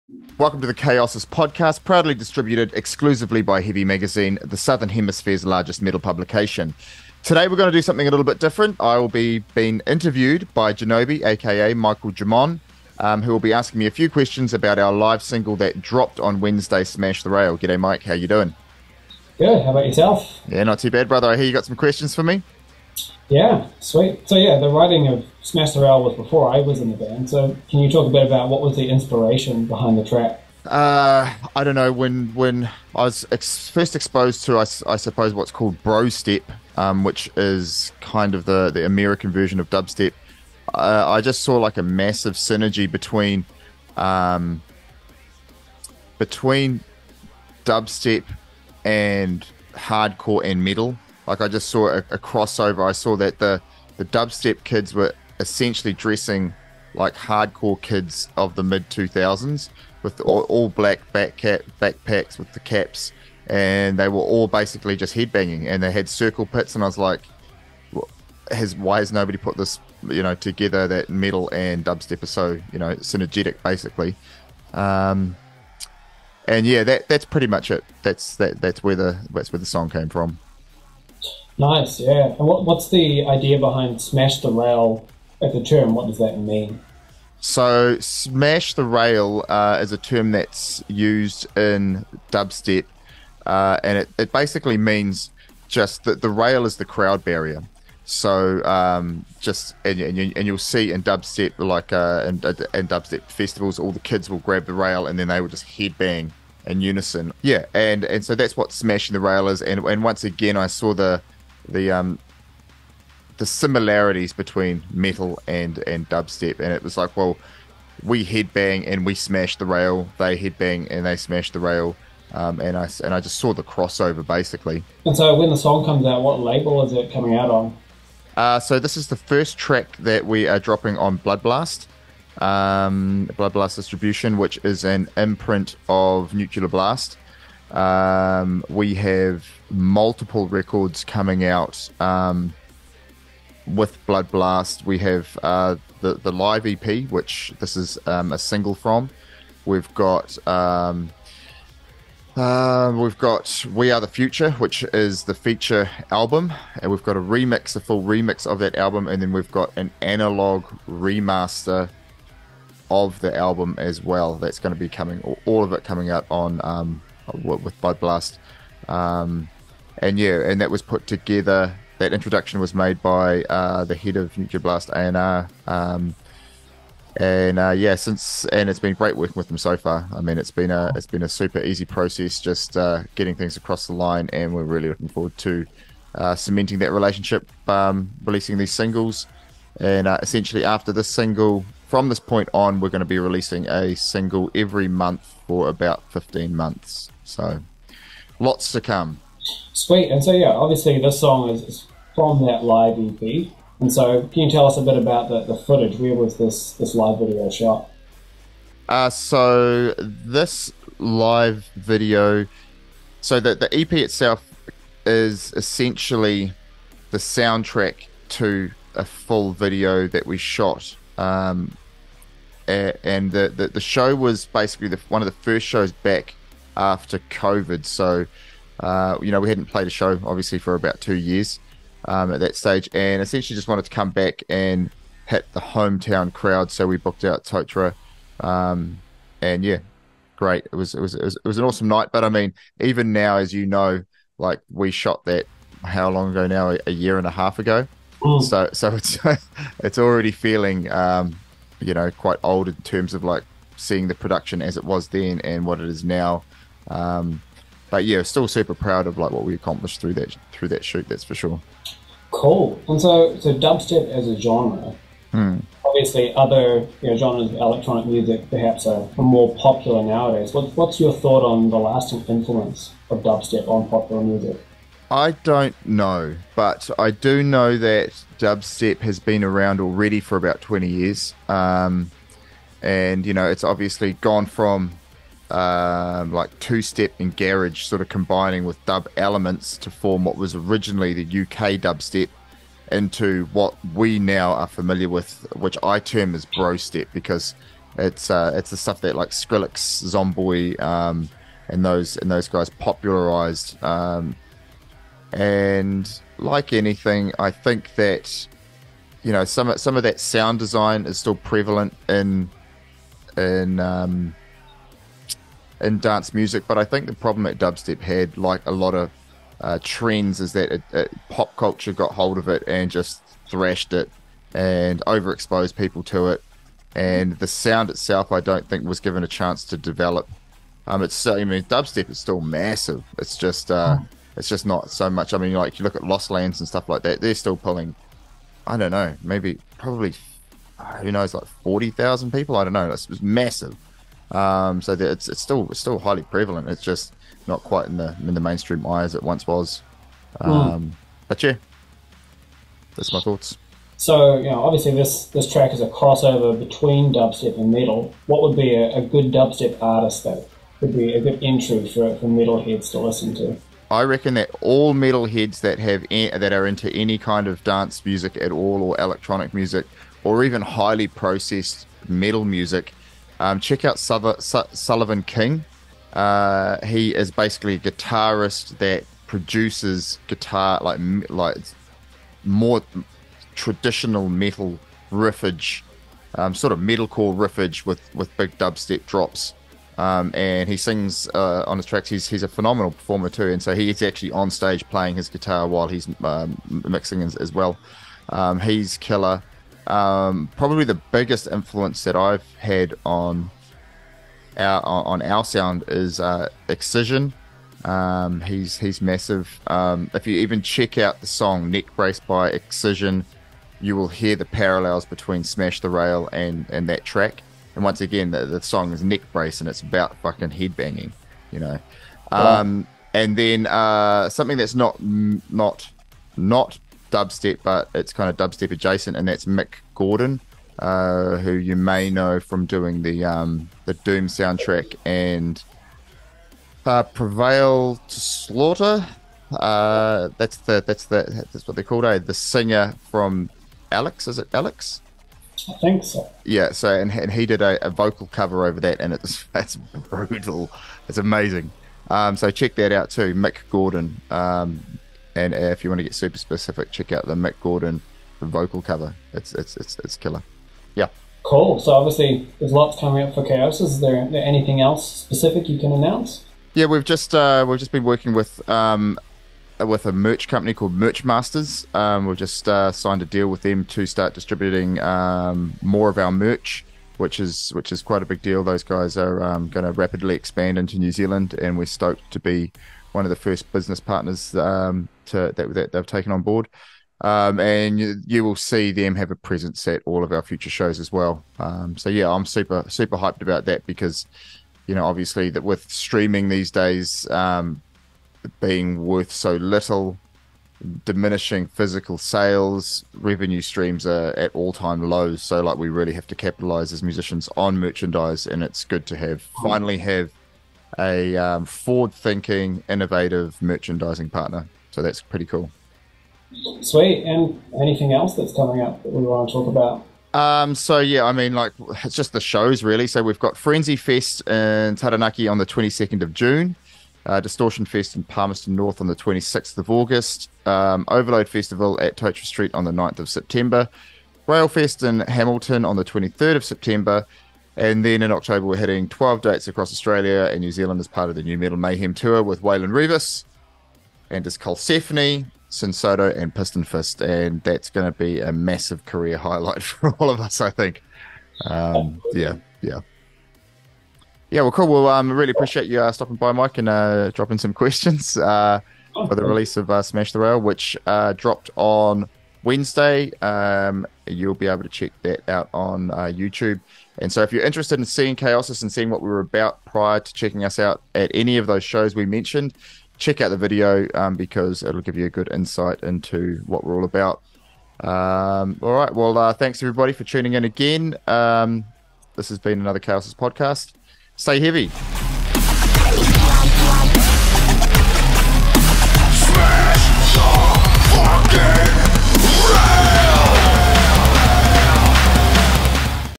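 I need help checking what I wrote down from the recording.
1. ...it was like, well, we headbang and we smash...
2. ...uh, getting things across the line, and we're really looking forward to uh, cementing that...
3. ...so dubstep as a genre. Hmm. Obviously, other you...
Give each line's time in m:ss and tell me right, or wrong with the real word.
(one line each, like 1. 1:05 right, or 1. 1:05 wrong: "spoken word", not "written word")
1. 1:56 right
2. 3:02 right
3. 4:23 right.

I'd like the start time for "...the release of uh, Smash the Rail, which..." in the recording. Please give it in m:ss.
9:19.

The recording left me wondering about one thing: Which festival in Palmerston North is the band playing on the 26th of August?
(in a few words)
Distortion Fest.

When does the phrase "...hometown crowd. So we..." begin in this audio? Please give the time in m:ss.
3:55.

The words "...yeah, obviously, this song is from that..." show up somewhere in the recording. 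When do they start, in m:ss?
3:20.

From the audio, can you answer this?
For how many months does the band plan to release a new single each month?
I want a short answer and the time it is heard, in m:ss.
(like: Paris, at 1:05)
15, at 3:16.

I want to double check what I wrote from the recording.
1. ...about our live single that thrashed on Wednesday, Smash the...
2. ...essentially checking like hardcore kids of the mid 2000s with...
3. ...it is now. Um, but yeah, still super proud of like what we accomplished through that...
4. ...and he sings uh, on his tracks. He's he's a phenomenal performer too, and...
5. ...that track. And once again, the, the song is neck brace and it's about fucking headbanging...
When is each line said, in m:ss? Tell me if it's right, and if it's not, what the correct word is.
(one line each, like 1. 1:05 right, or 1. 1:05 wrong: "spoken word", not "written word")
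1. 0:14 wrong: "dropped", not "thrashed"
2. 0:55 wrong: "dressing", not "checking"
3. 4:15 right
4. 6:30 right
5. 6:56 right.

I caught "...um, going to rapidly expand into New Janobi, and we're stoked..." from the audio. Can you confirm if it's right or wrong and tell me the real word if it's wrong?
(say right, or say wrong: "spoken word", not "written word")
wrong: "Zealand", not "Janobi".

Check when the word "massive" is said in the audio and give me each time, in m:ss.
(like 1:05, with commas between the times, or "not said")
0:41, 5:32, 5:43, 6:49, 9:08.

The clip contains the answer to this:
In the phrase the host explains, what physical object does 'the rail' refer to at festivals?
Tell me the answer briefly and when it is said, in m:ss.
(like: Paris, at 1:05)
the crowd barrier, at 1:36.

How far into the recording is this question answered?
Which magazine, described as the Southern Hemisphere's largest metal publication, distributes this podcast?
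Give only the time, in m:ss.
0:03.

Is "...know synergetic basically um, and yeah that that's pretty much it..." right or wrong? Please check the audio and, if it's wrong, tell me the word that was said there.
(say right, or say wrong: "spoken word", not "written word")
right.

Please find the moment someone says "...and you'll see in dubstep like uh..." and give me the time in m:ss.
1:40.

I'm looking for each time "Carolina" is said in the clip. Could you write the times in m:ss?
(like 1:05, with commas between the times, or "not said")
not said.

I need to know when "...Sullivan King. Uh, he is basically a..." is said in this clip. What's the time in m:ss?
6:14.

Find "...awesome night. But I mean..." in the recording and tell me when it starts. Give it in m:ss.
4:01.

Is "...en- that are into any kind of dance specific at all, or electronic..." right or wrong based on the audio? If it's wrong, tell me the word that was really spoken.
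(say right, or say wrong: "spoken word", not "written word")
wrong: "music", not "specific".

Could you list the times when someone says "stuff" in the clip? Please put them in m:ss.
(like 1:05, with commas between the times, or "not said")
4:58, 5:36.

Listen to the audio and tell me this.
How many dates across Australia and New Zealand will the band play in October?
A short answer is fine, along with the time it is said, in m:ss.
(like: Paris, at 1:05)
12, at 8:59.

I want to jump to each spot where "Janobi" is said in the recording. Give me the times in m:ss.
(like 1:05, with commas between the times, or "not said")
0:10.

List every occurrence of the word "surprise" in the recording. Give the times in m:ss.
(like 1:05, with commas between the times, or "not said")
not said.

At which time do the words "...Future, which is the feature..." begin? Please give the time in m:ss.
2:34.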